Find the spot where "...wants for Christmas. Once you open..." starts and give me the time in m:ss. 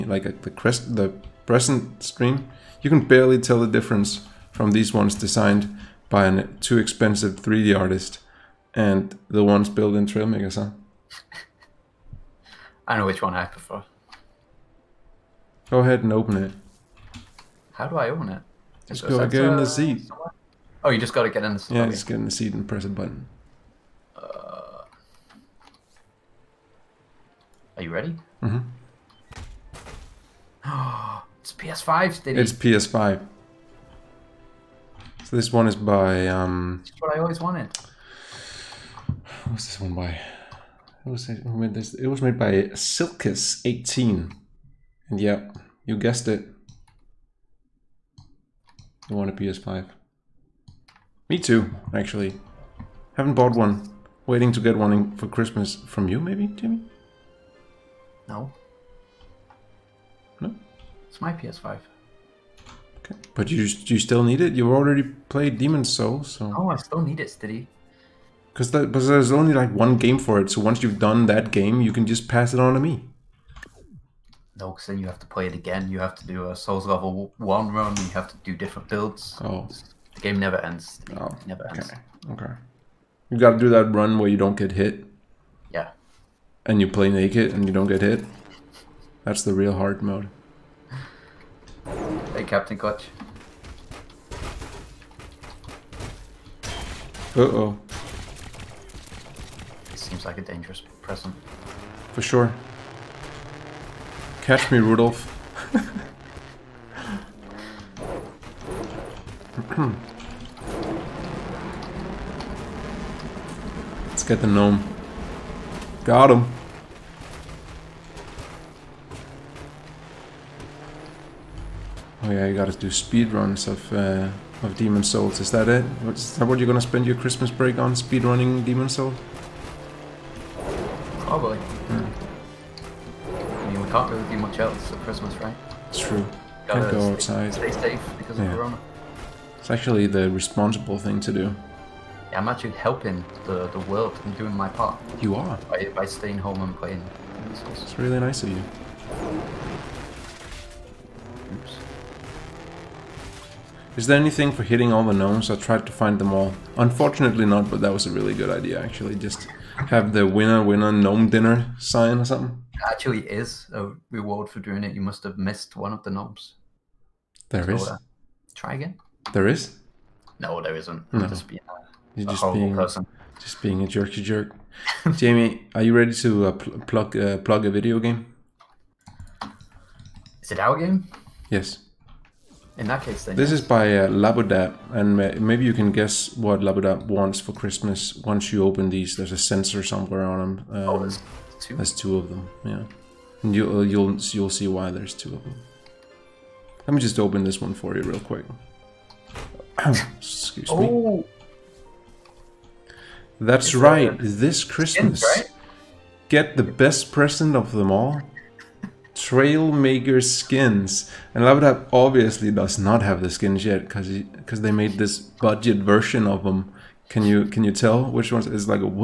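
3:07.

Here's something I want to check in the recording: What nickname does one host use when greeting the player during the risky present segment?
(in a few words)
Captain Clutch.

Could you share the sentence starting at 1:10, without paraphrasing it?
So once you've done that game, you can just pass it on to me.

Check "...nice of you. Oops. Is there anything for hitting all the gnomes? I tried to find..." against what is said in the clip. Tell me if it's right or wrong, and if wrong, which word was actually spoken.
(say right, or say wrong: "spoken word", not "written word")
right.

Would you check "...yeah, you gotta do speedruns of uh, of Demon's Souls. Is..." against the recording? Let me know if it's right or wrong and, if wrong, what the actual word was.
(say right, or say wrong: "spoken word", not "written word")
right.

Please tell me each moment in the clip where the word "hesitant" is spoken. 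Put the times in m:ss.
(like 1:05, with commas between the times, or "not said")
not said.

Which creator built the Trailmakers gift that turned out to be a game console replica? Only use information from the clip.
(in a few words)
Silkus18.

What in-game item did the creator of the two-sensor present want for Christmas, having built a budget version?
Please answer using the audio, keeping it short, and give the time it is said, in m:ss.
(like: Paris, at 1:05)
Trailmaker skins, at 3:29.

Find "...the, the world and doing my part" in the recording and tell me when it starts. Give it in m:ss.
2:23.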